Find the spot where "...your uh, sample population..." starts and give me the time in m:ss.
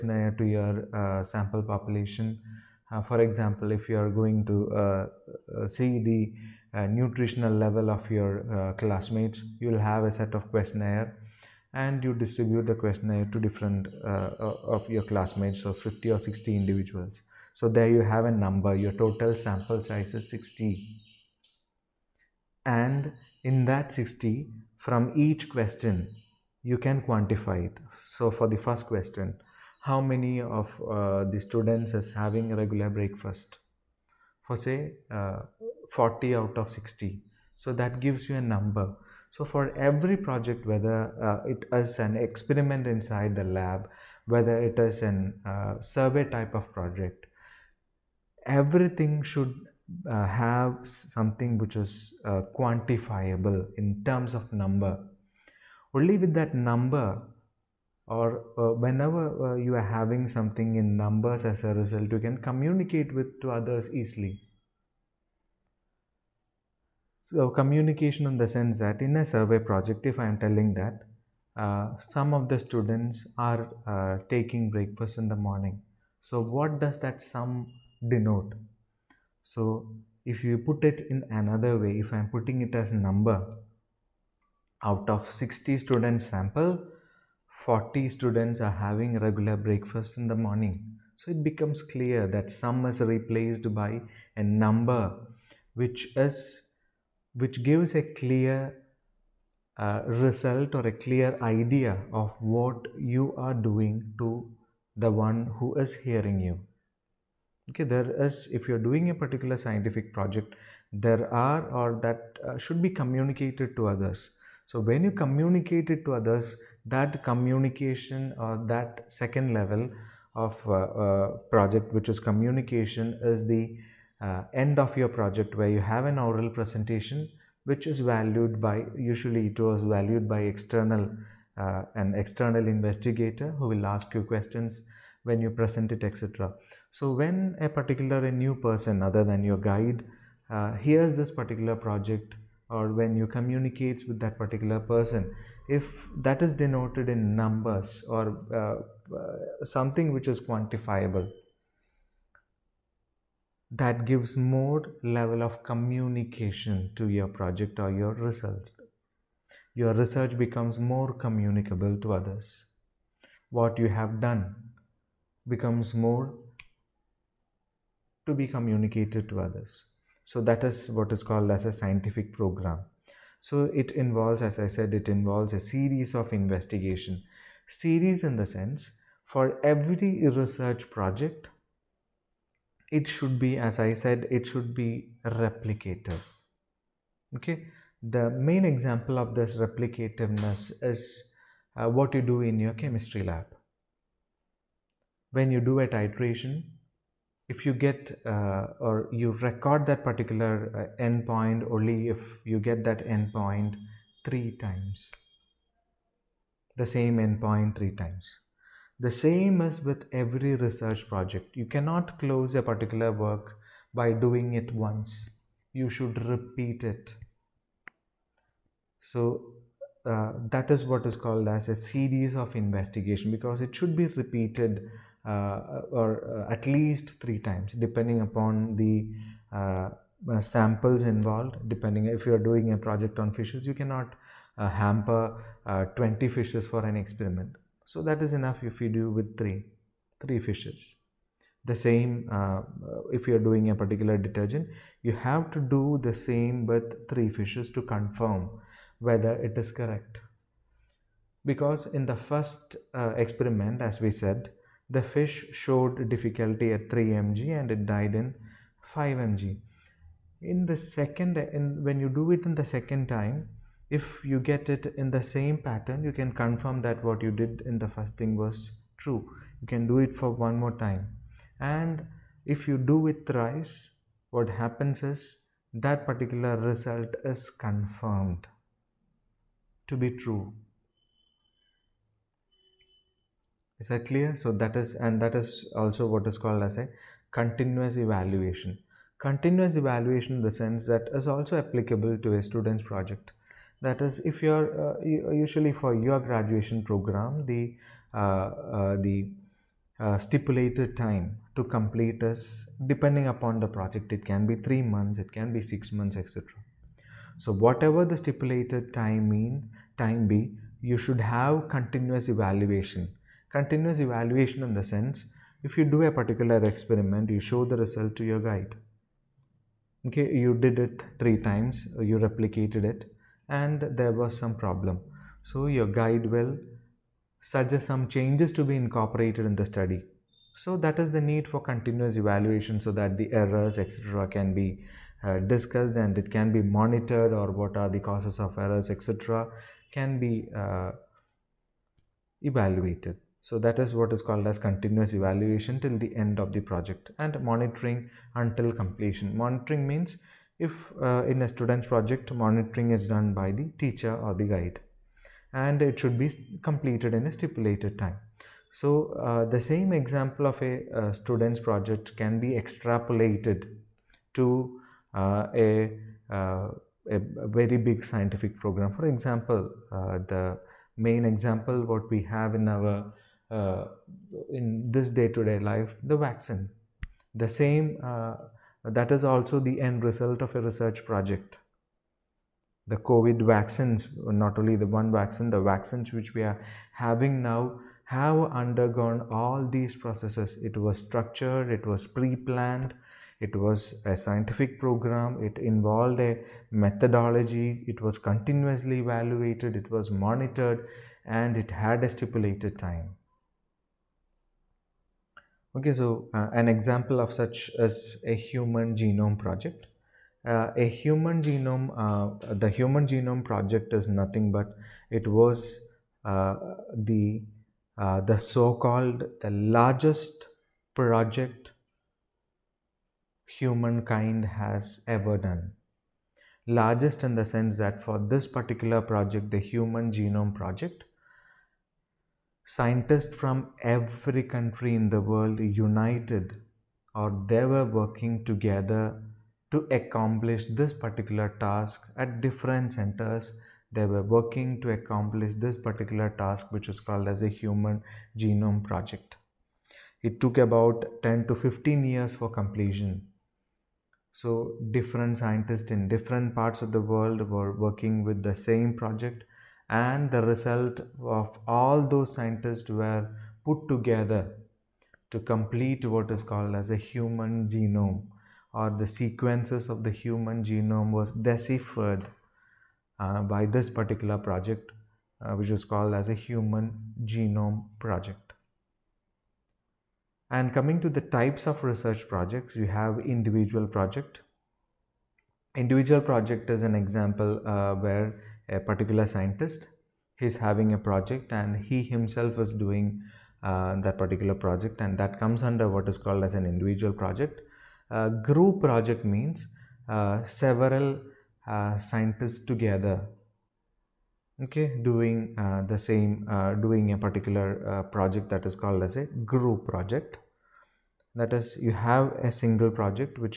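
0:00.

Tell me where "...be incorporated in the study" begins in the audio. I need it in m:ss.
5:28.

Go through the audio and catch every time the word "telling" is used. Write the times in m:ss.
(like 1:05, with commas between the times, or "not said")
1:10.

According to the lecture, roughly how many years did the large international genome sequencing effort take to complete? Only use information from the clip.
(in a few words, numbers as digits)
10 to 15 years.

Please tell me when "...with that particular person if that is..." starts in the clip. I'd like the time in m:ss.
2:24.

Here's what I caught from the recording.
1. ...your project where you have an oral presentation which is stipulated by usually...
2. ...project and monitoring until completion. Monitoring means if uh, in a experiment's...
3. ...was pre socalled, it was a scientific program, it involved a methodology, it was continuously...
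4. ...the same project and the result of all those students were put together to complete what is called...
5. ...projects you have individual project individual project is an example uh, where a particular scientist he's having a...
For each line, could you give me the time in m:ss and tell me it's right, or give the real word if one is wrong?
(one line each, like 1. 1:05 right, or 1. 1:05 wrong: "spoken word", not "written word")
1. 2:04 wrong: "valued", not "stipulated"
2. 5:46 wrong: "student", not "experiment"
3. 6:31 wrong: "planned", not "socalled"
4. 7:38 wrong: "scientists", not "students"
5. 8:02 right.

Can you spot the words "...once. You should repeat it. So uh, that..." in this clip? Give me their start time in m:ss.
3:34.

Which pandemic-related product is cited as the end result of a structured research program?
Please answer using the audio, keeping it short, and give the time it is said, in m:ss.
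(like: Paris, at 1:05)
COVID vaccines, at 6:22.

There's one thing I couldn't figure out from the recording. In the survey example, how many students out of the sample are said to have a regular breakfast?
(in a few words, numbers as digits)
40.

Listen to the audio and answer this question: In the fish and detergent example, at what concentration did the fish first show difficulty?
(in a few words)
3 mg.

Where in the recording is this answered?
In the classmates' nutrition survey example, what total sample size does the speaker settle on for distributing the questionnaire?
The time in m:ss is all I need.
0:18.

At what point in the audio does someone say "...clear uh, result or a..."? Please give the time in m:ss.
1:38.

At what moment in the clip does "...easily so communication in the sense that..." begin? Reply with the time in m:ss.
1:03.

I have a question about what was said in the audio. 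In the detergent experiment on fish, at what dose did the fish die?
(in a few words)
5 mg.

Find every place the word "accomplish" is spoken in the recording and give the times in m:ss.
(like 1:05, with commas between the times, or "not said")
7:19, 7:24.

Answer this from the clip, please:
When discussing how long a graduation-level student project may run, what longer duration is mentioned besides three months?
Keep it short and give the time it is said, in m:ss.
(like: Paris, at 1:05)
6 months, at 5:05.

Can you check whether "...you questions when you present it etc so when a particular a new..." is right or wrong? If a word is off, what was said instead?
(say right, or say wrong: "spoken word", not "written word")
right.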